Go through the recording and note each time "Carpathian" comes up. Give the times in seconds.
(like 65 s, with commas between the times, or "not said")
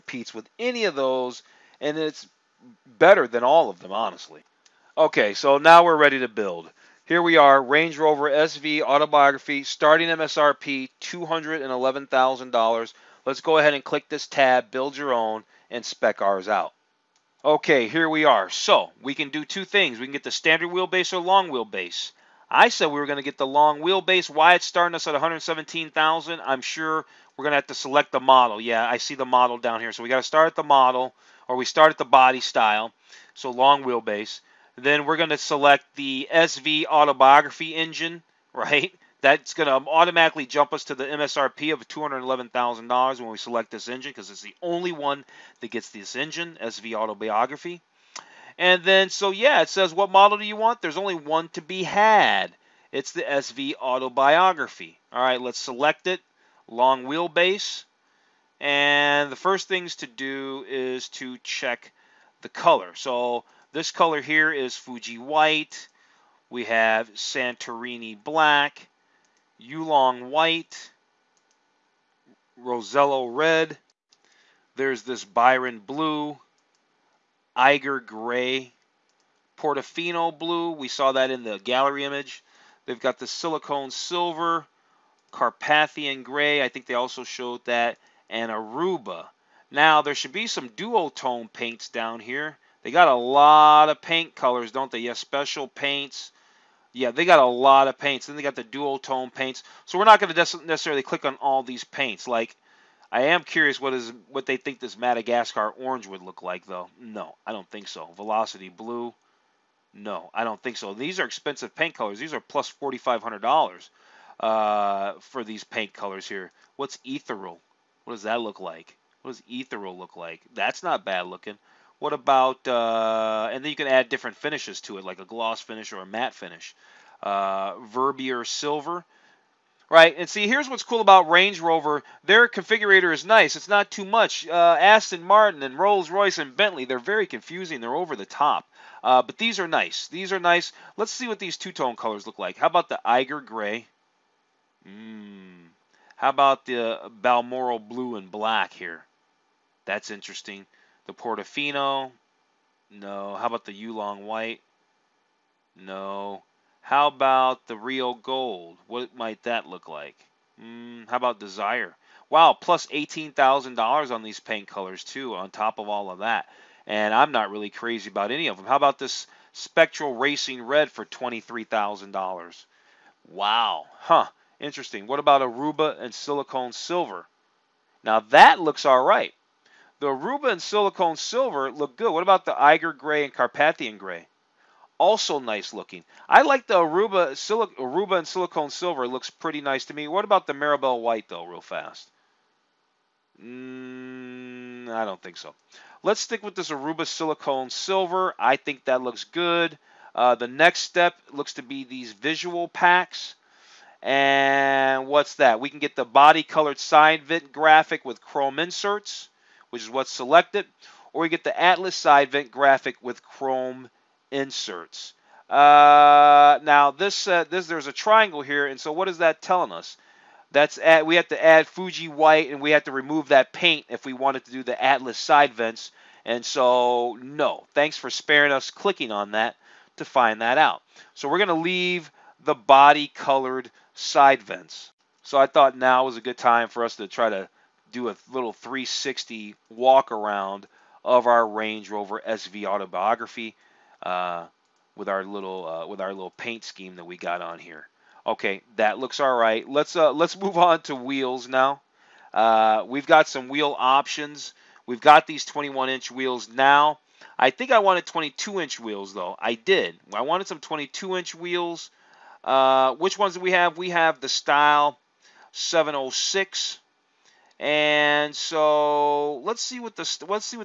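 85 s, 183 s.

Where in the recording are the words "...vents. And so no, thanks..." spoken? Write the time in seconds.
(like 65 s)
225 s.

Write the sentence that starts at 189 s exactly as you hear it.
It looks pretty nice to me.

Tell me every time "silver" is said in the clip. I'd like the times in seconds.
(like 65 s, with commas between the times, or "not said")
83 s, 128 s, 176 s, 181 s, 188 s, 197 s.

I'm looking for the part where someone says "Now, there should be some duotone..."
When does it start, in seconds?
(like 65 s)
89 s.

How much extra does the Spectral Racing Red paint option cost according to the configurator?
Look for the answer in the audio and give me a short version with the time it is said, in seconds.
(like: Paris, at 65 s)
$23,000, at 171 s.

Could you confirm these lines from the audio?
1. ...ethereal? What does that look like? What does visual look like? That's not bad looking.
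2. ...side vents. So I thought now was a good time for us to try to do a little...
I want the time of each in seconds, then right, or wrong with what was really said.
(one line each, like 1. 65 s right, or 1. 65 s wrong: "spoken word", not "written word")
1. 117 s wrong: "ethereal", not "visual"
2. 233 s right.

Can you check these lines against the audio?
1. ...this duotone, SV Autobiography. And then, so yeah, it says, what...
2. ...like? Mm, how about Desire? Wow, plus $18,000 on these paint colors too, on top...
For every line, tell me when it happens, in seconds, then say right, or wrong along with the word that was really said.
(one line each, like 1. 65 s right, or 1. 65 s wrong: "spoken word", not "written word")
1. 45 s wrong: "engine", not "duotone"
2. 159 s right.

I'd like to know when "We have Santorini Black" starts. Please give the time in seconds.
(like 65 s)
66 s.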